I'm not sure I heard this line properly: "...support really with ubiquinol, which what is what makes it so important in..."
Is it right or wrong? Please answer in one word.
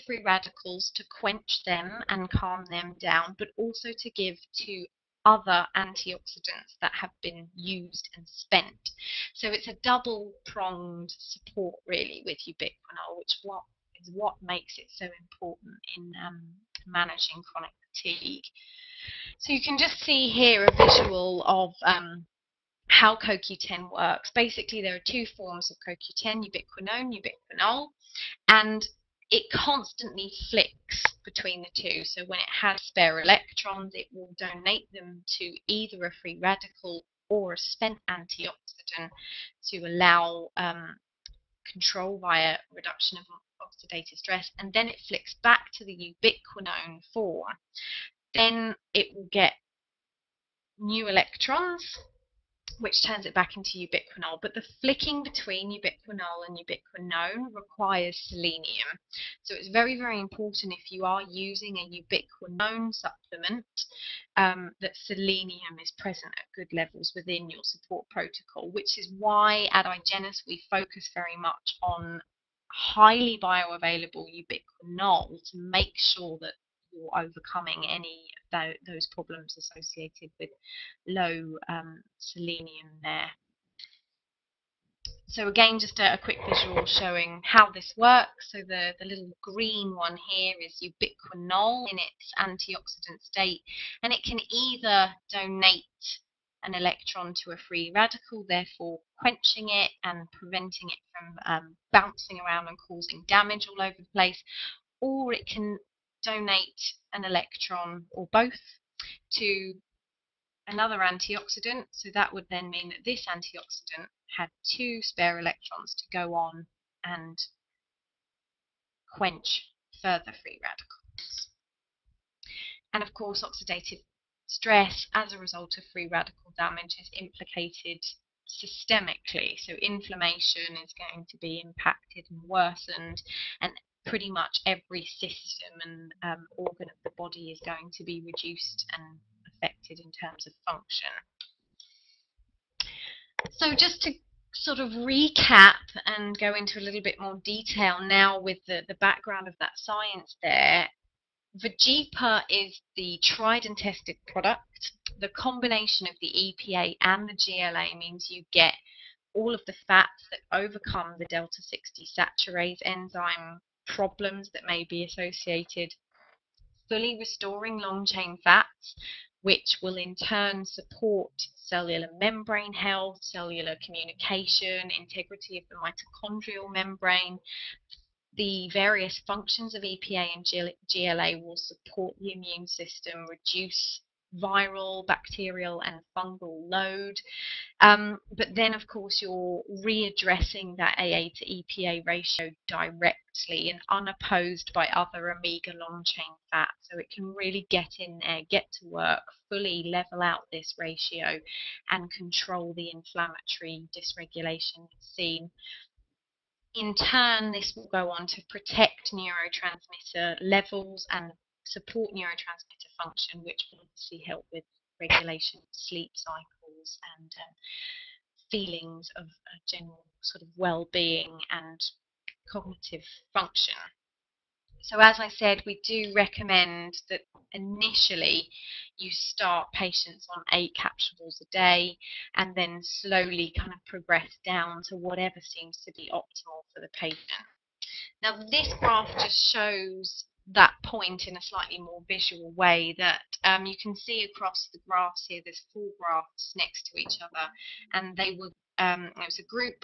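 right.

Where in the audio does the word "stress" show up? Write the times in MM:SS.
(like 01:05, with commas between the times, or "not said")
00:44, 02:04.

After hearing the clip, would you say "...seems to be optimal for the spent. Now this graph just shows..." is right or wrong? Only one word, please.
wrong.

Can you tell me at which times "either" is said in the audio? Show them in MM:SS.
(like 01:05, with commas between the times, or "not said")
00:35, 01:34.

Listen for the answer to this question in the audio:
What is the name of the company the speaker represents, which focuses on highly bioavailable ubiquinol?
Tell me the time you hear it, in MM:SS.
01:09.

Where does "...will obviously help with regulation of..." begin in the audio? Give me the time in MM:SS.
03:33.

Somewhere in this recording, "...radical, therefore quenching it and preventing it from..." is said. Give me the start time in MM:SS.
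01:37.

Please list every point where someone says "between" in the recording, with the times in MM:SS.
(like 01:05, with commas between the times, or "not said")
00:31, 00:55.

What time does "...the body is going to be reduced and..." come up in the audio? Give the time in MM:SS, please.
02:17.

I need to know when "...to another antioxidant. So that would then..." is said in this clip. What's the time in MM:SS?
01:49.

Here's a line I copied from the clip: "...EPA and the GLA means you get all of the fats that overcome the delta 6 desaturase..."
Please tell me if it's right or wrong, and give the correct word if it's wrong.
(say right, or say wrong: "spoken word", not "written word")
right.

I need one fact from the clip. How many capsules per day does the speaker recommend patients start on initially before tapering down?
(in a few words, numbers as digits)
8.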